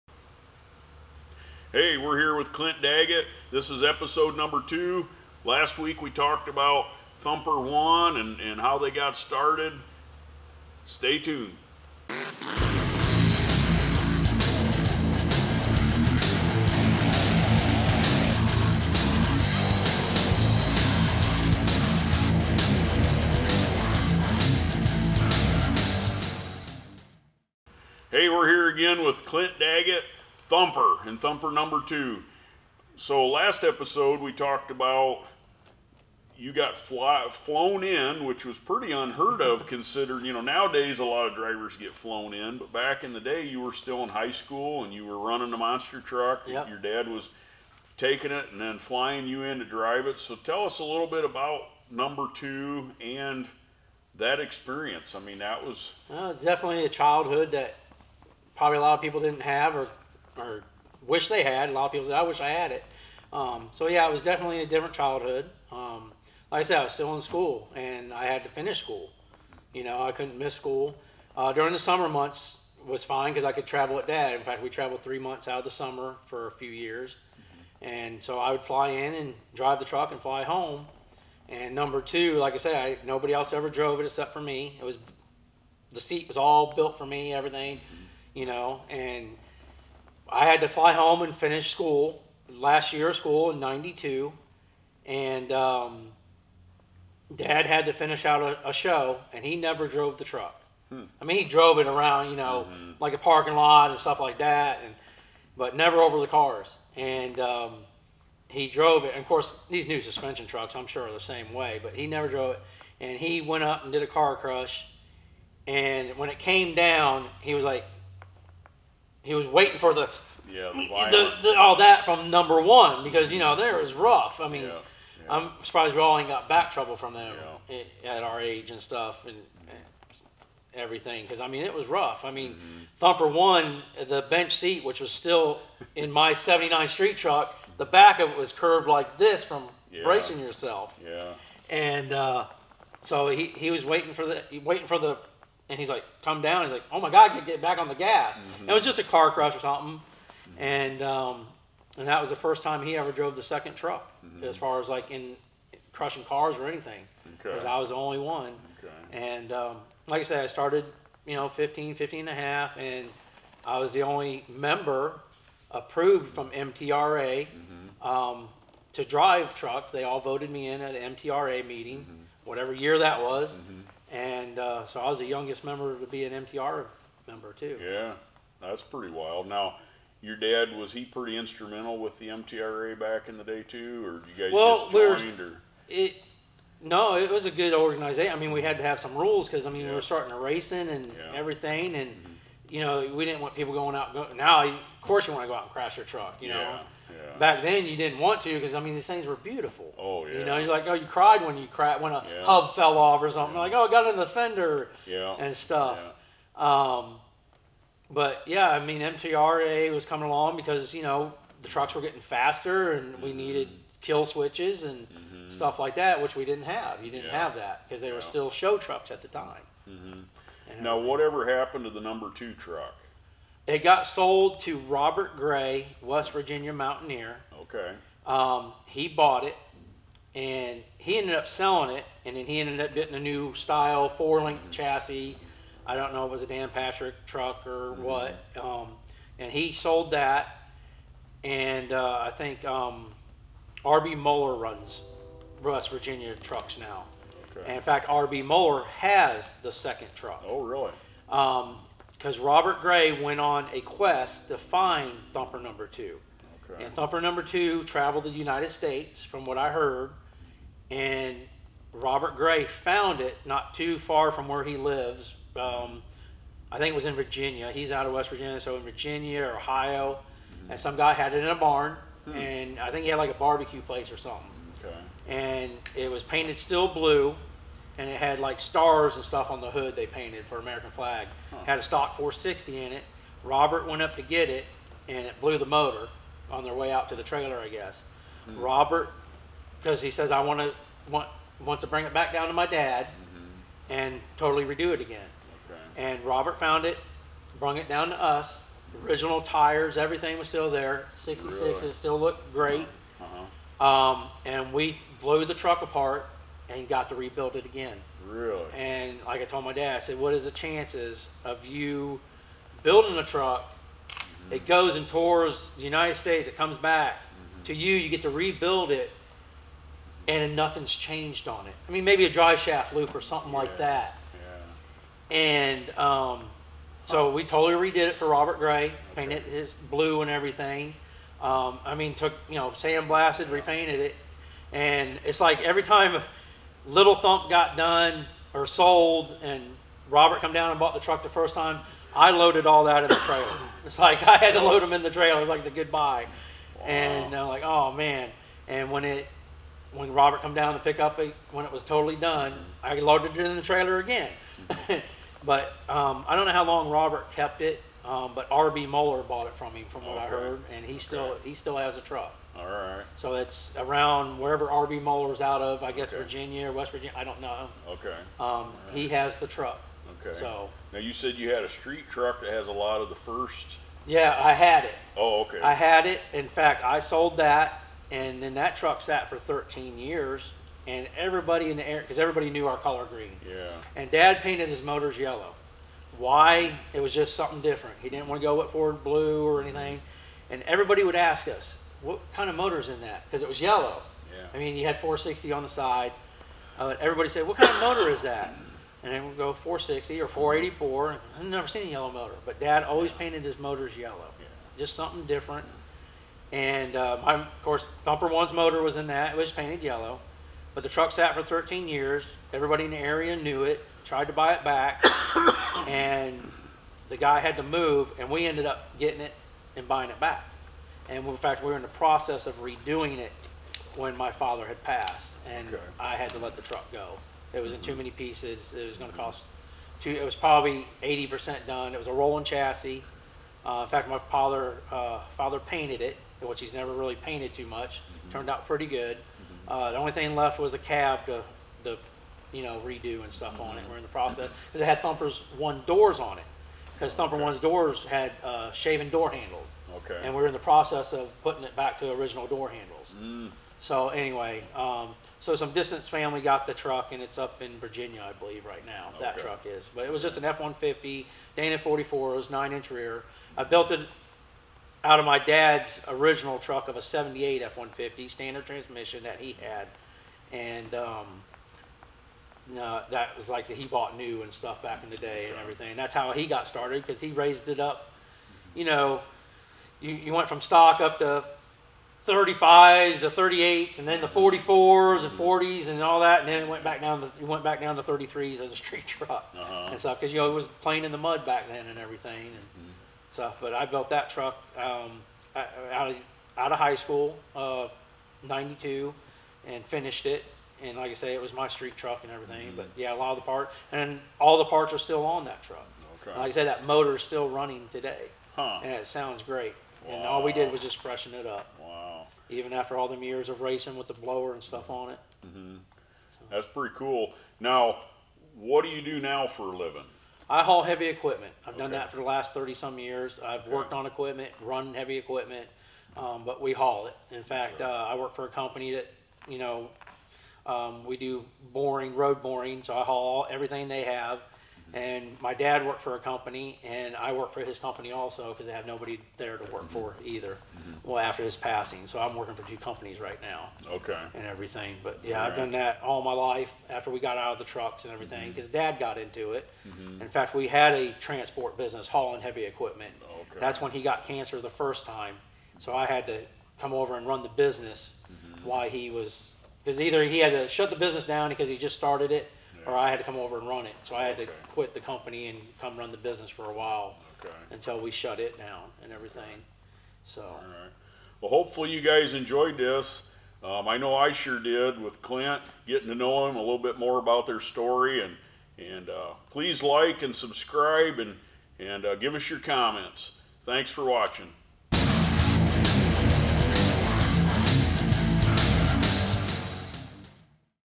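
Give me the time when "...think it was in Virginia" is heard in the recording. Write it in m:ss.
4:26.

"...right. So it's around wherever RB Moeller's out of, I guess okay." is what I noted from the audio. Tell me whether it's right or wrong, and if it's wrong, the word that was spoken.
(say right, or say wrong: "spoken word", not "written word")
right.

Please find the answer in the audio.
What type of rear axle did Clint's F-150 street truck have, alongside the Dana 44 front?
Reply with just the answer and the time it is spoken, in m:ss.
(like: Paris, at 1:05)
Nine inch, at 7:42.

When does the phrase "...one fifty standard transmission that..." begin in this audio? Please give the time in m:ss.
7:47.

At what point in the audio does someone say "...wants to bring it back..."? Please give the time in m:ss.
4:51.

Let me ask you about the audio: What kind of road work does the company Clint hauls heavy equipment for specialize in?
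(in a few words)
Road boring.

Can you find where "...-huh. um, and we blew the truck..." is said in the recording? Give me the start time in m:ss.
5:03.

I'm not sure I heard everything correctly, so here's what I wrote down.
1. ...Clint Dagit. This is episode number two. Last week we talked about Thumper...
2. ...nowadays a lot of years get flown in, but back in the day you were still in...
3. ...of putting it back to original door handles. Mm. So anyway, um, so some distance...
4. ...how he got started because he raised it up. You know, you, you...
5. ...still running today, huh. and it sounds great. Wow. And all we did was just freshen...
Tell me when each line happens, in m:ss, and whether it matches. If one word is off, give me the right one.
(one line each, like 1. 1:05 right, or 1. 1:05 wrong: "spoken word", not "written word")
1. 0:02 right
2. 0:40 wrong: "drivers", not "years"
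3. 7:31 right
4. 7:56 right
5. 8:27 right.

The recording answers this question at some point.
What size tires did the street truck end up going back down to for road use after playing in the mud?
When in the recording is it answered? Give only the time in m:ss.
8:08.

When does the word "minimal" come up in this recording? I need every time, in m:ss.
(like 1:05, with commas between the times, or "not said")
not said.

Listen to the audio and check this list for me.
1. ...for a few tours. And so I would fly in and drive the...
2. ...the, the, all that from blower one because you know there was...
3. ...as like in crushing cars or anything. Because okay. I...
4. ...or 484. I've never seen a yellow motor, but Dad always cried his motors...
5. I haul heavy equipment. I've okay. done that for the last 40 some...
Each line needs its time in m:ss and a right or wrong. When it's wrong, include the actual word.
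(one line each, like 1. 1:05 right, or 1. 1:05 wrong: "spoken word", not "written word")
1. 1:16 wrong: "years", not "tours"
2. 2:01 wrong: "number", not "blower"
3. 2:34 right
4. 6:40 wrong: "painted", not "cried"
5. 8:40 wrong: "30", not "40".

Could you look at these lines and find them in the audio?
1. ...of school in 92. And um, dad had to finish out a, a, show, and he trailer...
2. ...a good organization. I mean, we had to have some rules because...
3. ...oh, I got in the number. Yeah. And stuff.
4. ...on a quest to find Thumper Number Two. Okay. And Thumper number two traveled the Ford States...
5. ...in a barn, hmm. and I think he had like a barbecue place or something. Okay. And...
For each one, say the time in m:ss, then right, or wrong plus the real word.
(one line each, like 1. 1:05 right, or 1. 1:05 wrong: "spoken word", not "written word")
1. 1:33 wrong: "never", not "trailer"
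2. 3:07 right
3. 3:23 wrong: "fender", not "number"
4. 4:13 wrong: "United", not "Ford"
5. 4:31 right.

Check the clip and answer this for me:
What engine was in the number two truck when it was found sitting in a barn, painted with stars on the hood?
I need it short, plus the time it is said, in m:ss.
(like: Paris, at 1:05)
Stock 460, at 4:41.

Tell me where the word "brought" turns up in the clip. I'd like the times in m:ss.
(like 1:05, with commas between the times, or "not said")
4:57.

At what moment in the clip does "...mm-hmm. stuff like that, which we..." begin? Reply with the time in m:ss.
3:35.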